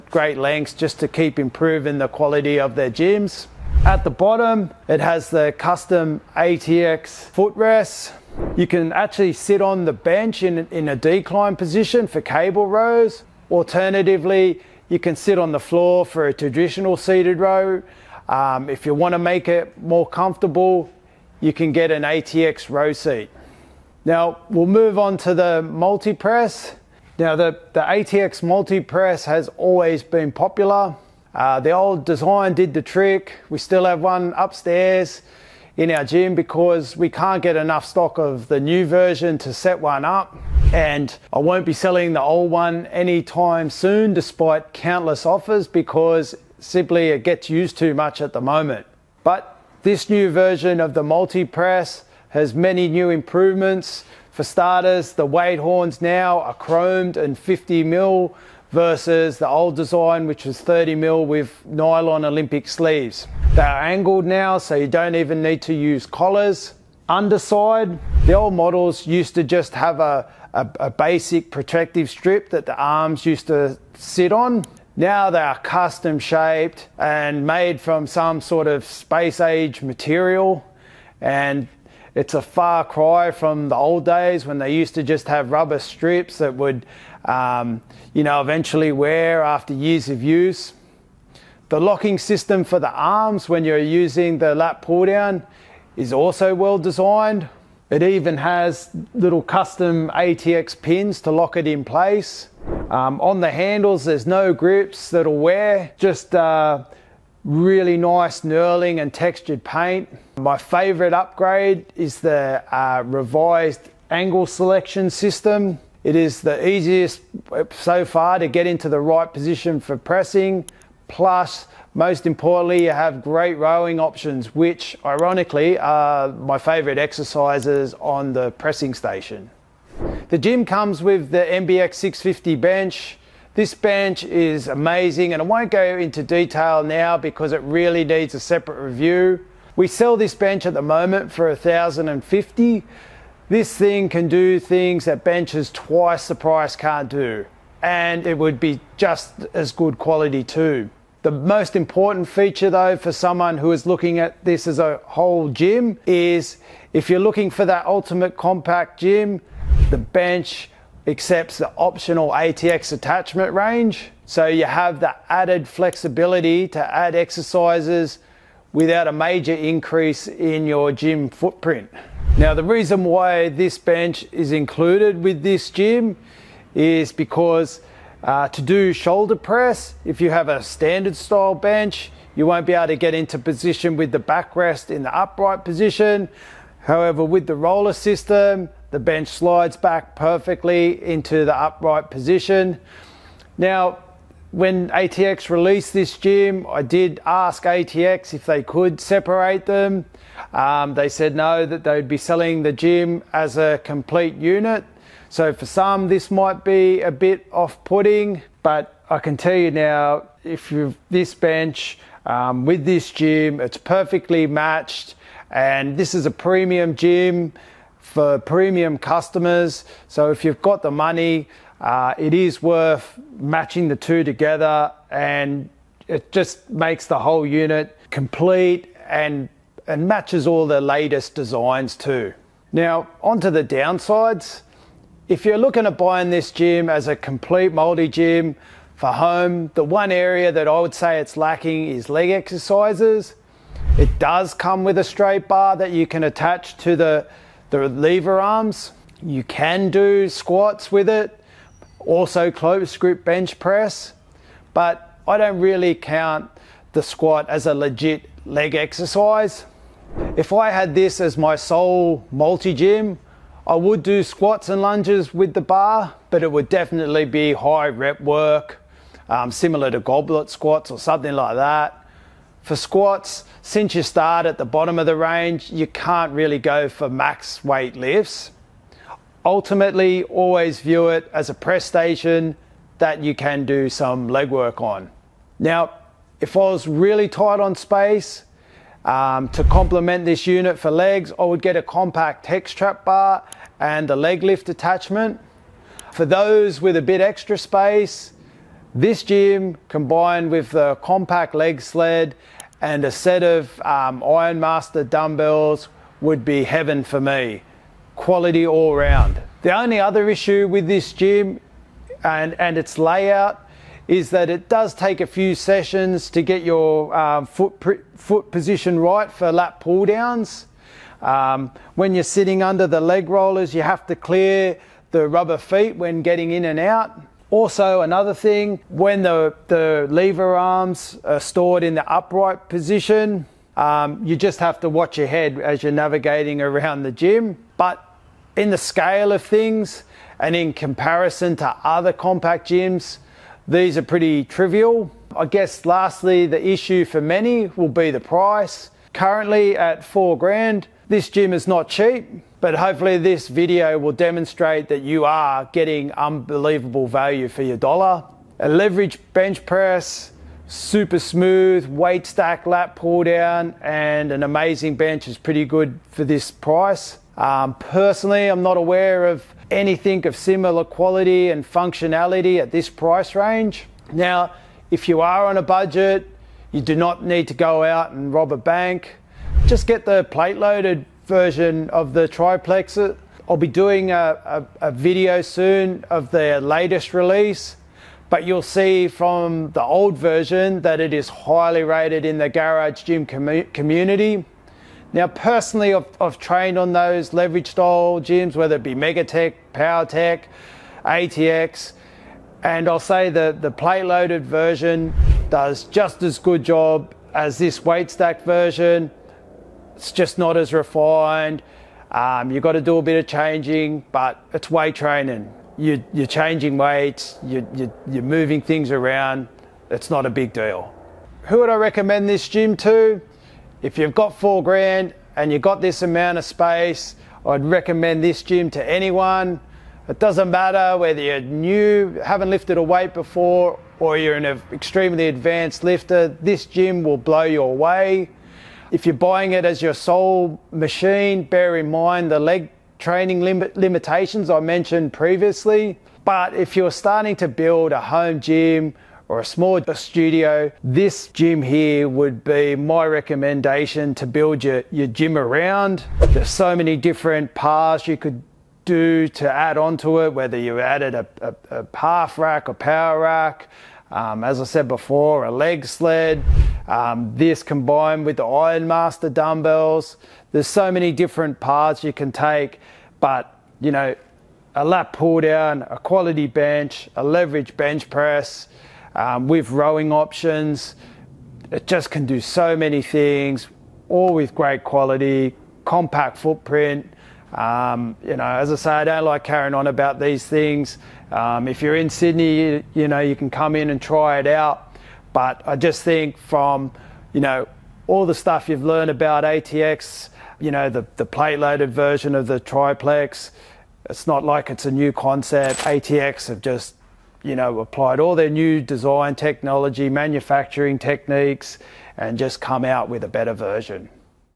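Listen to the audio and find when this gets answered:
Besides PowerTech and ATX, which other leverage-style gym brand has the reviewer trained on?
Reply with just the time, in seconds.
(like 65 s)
398 s.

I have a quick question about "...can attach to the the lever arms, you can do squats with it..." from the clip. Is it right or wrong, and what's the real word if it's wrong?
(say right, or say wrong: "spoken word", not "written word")
right.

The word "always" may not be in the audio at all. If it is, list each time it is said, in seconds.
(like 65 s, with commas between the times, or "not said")
29 s, 280 s.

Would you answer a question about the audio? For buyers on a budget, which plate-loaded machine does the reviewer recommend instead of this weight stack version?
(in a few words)
triplexer.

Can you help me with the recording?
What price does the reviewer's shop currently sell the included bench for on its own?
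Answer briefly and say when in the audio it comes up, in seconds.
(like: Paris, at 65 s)
1050, at 141 s.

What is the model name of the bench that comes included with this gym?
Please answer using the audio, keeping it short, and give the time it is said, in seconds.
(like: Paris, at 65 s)
MBX 650, at 131 s.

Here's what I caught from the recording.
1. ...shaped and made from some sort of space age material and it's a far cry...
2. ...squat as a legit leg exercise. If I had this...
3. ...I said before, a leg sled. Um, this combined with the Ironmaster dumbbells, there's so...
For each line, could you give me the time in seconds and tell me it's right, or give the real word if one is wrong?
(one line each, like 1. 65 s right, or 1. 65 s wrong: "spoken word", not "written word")
1. 76 s right
2. 257 s right
3. 464 s right.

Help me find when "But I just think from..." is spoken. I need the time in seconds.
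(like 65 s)
495 s.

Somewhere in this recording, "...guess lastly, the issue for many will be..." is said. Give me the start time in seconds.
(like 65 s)
345 s.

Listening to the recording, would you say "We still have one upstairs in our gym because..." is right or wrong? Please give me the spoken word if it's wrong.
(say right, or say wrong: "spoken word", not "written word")
right.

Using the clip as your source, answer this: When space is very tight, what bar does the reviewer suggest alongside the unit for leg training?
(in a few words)
compact hex trap bar.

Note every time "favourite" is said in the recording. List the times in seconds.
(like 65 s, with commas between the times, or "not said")
110 s, 126 s.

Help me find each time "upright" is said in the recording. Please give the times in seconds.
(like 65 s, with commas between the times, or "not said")
185 s, 191 s, 332 s.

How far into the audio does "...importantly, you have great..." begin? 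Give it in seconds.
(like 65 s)
122 s.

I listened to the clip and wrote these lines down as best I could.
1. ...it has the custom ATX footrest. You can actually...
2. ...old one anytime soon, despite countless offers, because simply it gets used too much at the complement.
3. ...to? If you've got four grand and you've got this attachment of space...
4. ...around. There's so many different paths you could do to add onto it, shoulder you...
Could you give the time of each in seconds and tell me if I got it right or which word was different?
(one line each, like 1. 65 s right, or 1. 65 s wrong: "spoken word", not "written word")
1. 4 s right
2. 42 s wrong: "moment", not "complement"
3. 422 s wrong: "amount", not "attachment"
4. 455 s wrong: "whether", not "shoulder".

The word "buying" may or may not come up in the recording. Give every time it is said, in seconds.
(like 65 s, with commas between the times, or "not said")
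235 s, 439 s.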